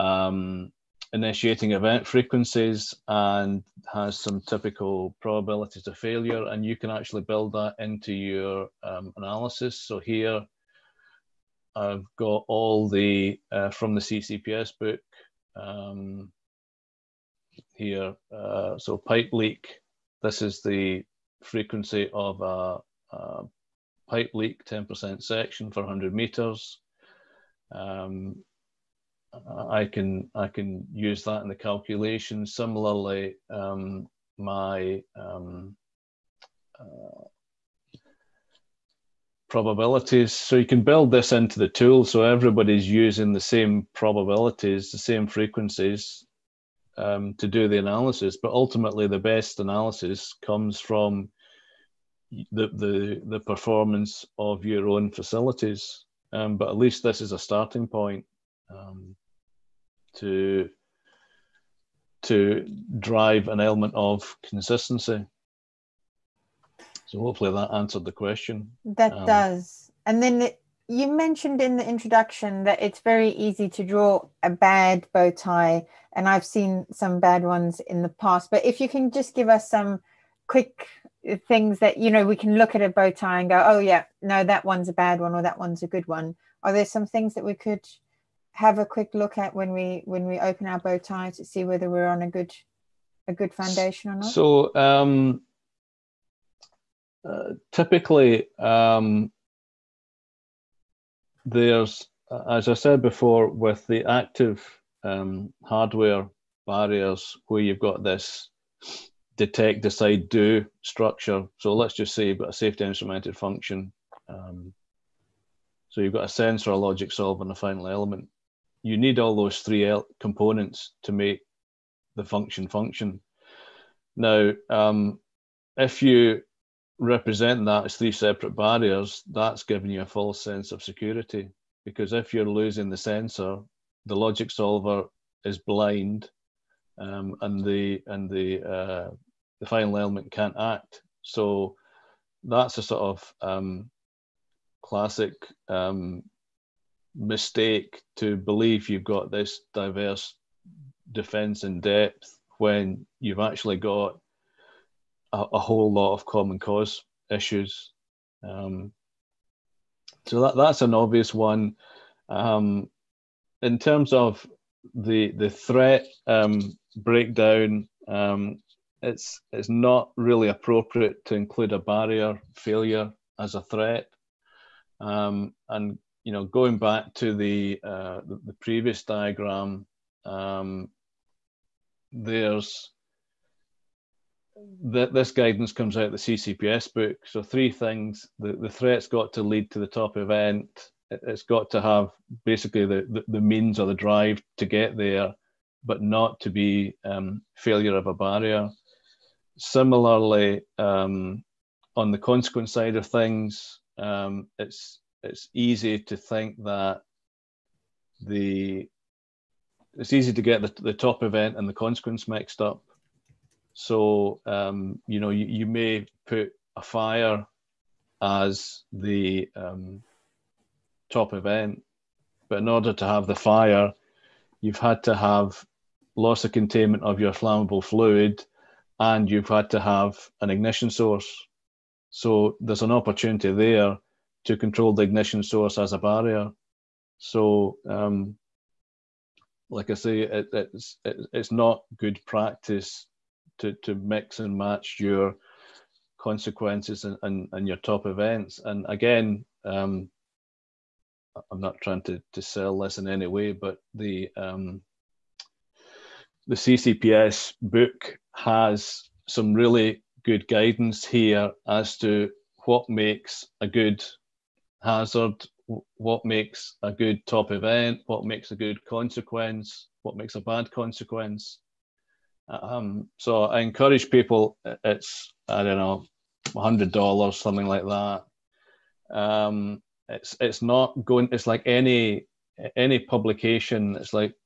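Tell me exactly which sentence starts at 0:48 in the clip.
But ultimately, the best analysis comes from the, the, the performance of your own facilities.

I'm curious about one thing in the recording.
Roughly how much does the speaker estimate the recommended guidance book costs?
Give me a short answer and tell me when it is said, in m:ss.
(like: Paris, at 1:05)
$100, at 4:36.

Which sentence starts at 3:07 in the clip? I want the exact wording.
So three things: the, the threat's got to lead to the top event.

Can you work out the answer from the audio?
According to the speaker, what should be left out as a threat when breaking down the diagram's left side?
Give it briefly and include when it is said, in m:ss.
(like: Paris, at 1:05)
A barrier failure, at 2:51.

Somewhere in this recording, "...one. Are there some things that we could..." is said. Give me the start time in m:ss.
1:26.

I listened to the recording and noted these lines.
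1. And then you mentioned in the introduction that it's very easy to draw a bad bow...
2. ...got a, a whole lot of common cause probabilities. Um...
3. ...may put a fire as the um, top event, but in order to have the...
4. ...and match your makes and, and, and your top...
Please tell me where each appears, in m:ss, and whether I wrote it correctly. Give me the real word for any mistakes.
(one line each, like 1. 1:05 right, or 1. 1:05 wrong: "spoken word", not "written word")
1. 1:10 right
2. 2:33 wrong: "issues", not "probabilities"
3. 3:35 right
4. 4:04 wrong: "consequences", not "makes".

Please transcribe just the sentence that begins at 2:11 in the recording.
Because if you're losing the sensor, the logic solver is blind, um, and the and the uh, the final element can't act.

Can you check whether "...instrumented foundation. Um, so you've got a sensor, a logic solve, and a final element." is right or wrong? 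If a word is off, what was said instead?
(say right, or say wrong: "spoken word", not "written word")
wrong: "function", not "foundation".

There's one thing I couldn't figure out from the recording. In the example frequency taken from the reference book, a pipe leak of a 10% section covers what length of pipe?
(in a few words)
100 meters.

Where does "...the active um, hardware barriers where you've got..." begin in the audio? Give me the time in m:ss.
1:43.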